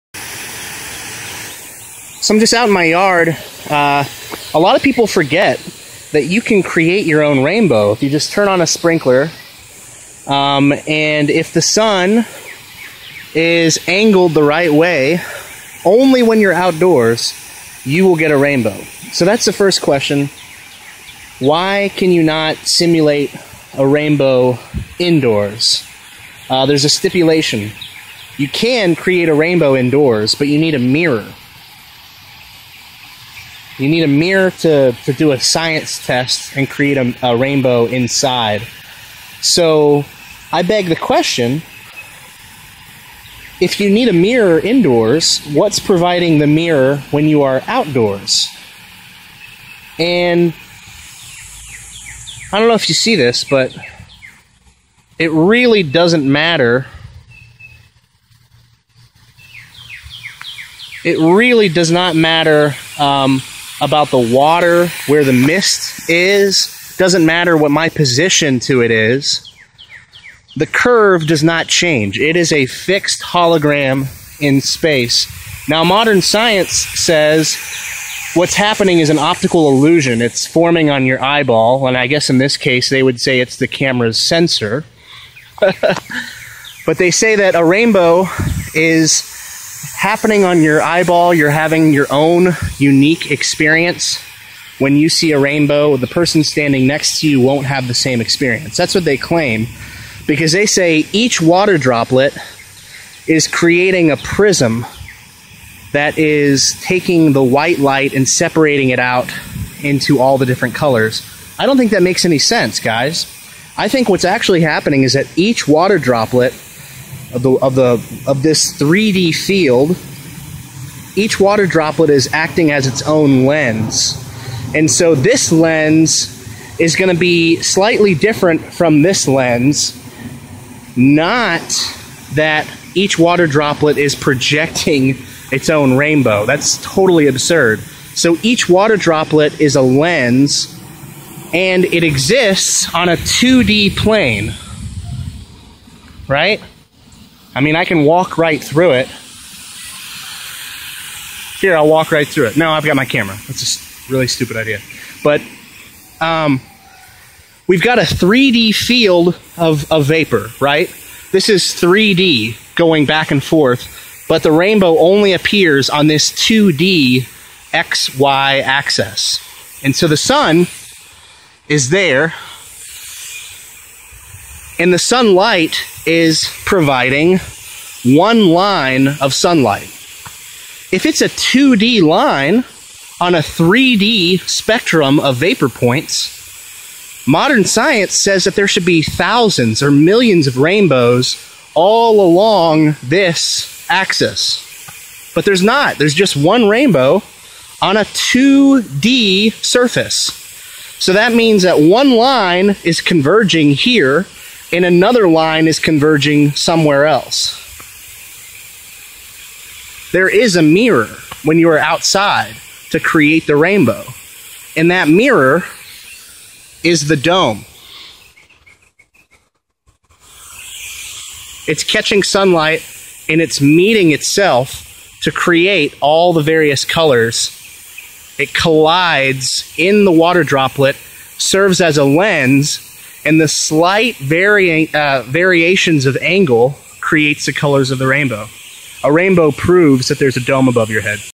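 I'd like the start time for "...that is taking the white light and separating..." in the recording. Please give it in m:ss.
1:45.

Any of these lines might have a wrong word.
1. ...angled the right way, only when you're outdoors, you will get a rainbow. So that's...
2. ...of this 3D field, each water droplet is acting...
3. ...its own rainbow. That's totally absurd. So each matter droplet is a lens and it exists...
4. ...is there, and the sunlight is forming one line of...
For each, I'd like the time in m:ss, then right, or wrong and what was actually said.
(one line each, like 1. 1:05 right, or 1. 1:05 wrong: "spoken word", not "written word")
1. 0:13 right
2. 1:58 right
3. 2:15 wrong: "water", not "matter"
4. 2:51 wrong: "providing", not "forming".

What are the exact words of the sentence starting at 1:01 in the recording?
It really does not matter um, about the water, where the mist is.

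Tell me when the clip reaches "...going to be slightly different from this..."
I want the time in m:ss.
2:06.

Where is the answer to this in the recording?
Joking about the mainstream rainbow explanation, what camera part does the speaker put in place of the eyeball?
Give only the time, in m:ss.
1:23.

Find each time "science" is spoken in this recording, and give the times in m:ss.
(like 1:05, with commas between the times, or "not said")
0:35, 1:16, 3:07.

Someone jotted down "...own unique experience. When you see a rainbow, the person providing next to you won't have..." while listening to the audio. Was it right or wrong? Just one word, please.
wrong.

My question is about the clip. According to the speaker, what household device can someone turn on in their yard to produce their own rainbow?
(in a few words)
A sprinkler.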